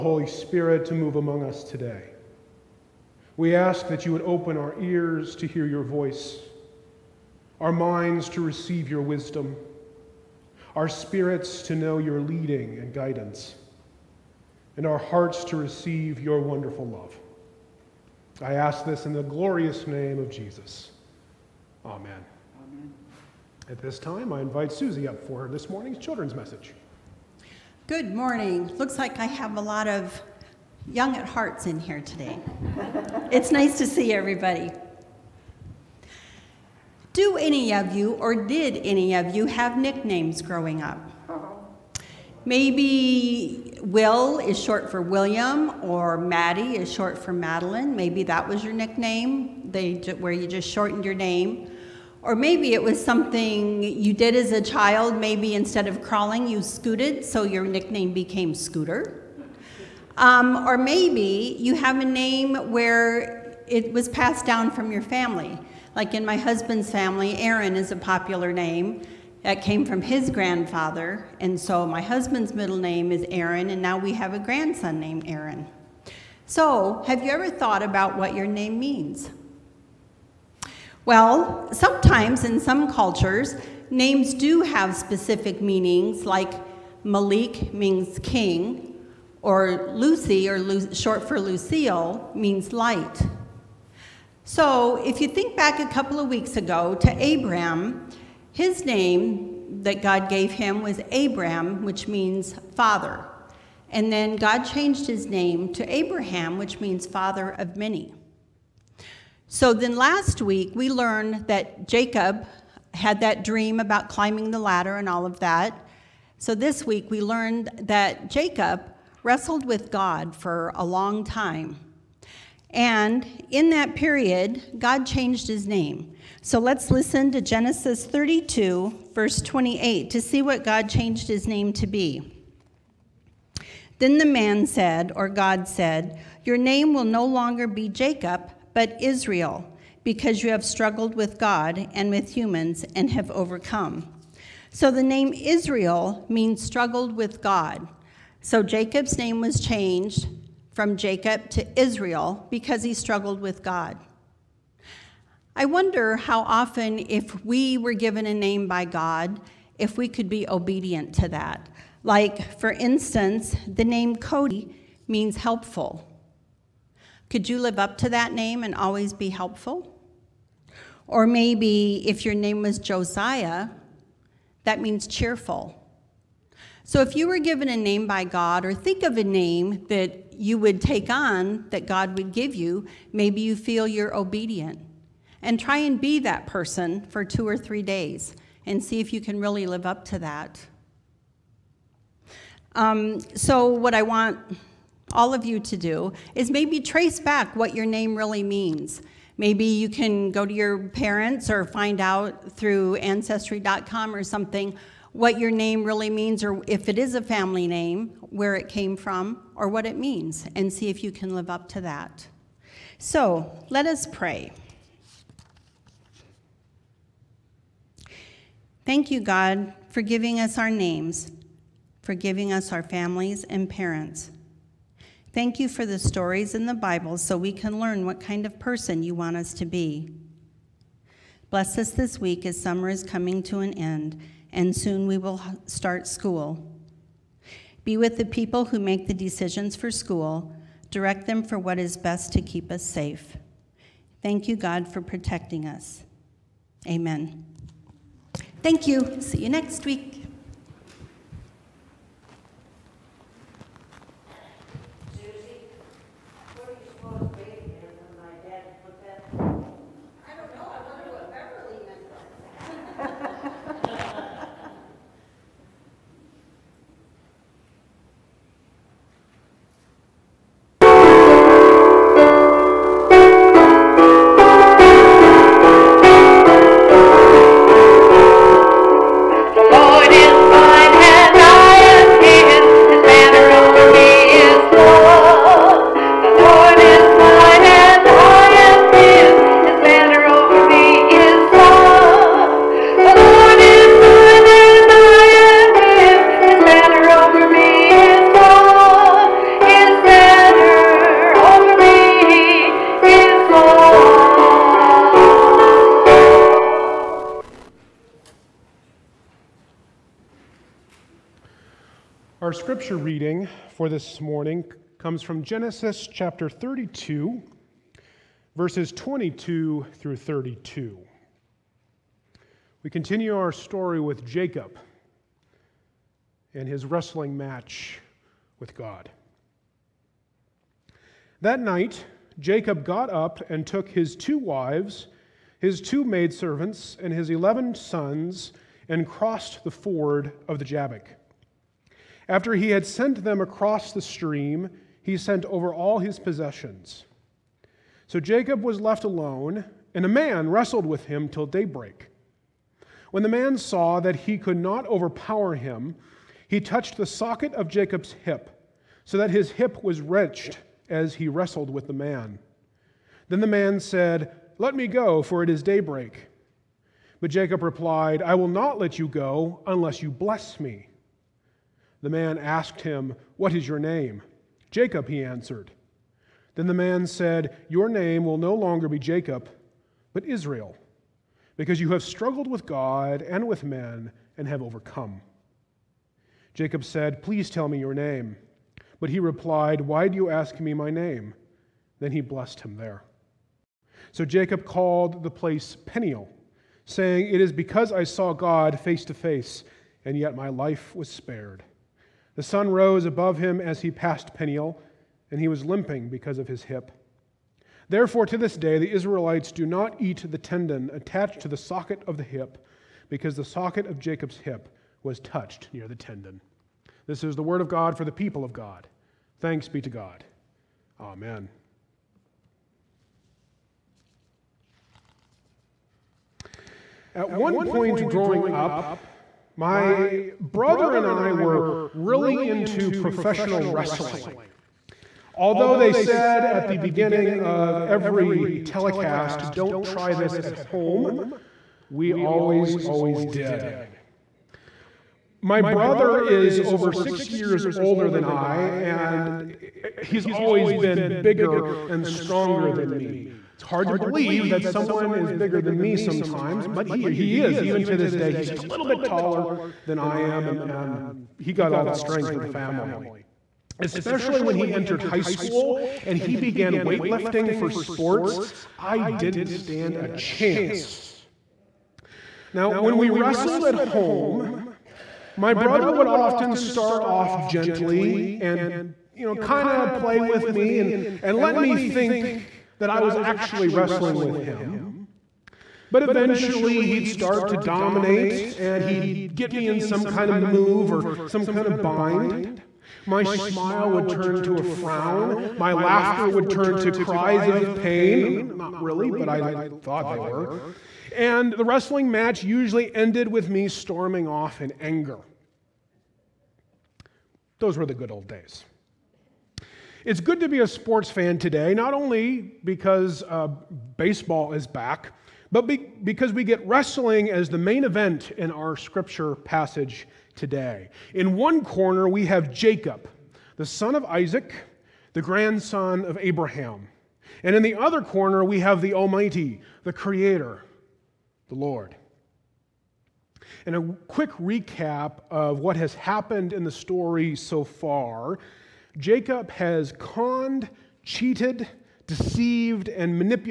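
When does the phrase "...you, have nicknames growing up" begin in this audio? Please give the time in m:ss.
0:39.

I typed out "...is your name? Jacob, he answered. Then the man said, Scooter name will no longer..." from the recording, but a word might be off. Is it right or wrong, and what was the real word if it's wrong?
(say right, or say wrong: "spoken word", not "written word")
wrong: "Your", not "Scooter".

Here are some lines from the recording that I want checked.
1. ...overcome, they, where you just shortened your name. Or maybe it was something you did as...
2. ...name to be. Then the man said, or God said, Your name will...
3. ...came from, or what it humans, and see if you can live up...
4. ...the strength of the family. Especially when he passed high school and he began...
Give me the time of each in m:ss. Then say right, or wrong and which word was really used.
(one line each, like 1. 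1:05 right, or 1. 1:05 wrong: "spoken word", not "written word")
1. 0:48 wrong: "nickname", not "overcome"
2. 2:11 right
3. 3:28 wrong: "means", not "humans"
4. 7:41 wrong: "entered", not "passed".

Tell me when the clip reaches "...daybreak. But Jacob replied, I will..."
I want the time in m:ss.
6:05.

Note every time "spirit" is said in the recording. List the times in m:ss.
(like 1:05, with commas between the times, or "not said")
0:00, 0:10.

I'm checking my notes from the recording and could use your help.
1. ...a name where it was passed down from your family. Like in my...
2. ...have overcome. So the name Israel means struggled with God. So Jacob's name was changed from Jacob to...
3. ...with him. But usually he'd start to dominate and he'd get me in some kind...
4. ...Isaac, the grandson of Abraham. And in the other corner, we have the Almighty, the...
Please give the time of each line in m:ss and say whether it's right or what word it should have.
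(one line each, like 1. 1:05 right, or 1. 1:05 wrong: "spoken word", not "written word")
1. 1:01 right
2. 2:23 right
3. 8:04 wrong: "eventually", not "usually"
4. 8:44 right.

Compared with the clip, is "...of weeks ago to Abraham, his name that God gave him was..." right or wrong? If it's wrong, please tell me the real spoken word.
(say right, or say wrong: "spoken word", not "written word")
right.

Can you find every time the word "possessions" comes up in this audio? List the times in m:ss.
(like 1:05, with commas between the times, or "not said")
5:46.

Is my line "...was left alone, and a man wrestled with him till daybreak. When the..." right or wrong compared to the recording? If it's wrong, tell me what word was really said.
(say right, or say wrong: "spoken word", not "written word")
right.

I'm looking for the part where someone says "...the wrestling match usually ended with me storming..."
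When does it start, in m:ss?
8:21.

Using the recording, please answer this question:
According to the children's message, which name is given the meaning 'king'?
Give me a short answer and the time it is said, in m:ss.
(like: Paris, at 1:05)
Malik, at 1:27.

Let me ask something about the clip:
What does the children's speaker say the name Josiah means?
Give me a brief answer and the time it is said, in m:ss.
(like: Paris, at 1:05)
cheerful, at 2:55.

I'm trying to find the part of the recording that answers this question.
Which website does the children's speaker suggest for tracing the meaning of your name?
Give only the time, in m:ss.
3:22.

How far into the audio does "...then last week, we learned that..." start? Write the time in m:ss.
1:49.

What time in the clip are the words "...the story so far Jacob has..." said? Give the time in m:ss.
8:56.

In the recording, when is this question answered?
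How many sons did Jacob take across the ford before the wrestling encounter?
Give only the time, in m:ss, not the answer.
5:37.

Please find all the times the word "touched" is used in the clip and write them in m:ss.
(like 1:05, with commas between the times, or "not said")
5:56, 6:55.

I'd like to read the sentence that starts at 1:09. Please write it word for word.
That came from his grandfather, and so my husband's middle name is Aaron, and now we have a grandson named Aaron.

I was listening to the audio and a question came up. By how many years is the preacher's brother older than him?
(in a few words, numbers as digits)
6.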